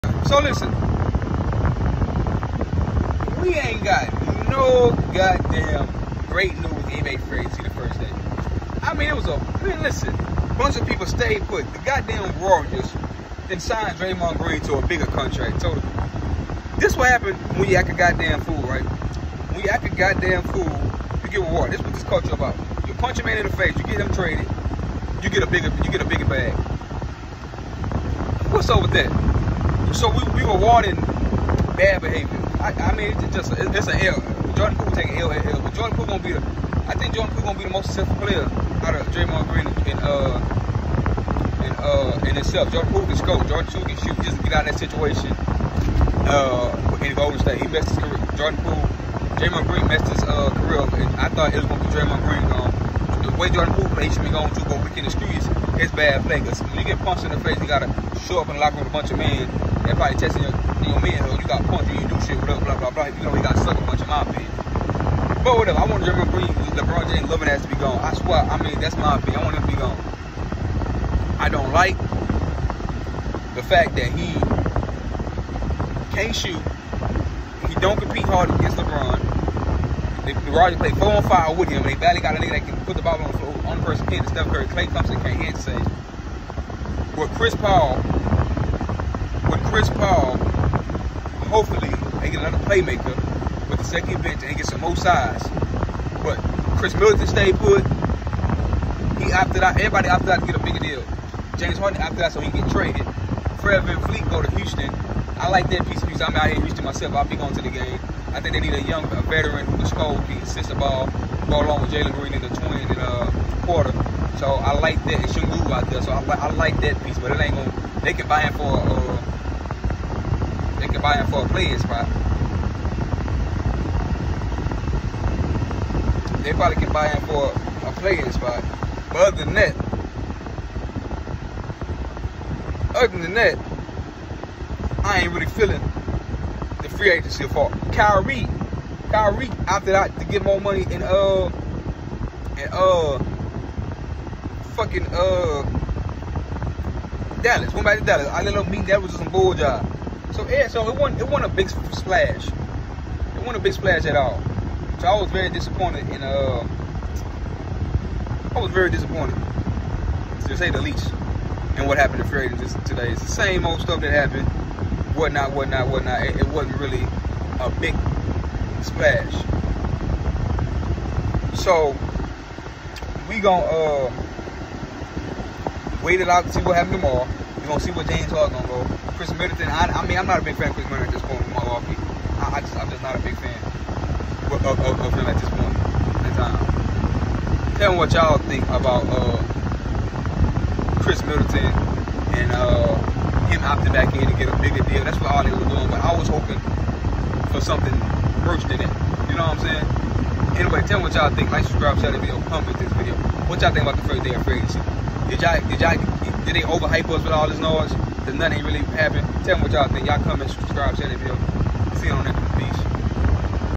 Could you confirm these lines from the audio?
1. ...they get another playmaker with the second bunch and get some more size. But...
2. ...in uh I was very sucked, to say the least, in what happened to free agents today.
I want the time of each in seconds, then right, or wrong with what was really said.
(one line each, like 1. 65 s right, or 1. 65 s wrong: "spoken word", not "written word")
1. 92 s wrong: "bench", not "bunch"
2. 156 s wrong: "disappointed", not "sucked".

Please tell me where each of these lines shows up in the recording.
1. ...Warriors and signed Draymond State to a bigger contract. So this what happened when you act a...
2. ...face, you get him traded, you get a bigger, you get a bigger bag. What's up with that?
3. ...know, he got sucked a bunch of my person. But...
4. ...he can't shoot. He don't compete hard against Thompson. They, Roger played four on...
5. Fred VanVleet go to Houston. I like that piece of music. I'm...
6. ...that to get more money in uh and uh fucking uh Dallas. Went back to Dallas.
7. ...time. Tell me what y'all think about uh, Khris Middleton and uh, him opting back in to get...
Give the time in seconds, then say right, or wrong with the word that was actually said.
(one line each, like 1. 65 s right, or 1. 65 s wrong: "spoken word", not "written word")
1. 12 s wrong: "Green", not "State"
2. 23 s right
3. 63 s wrong: "opinion", not "person"
4. 74 s wrong: "LeBron", not "Thompson"
5. 103 s right
6. 139 s right
7. 186 s right.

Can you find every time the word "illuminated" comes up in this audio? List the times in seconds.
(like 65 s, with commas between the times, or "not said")
not said.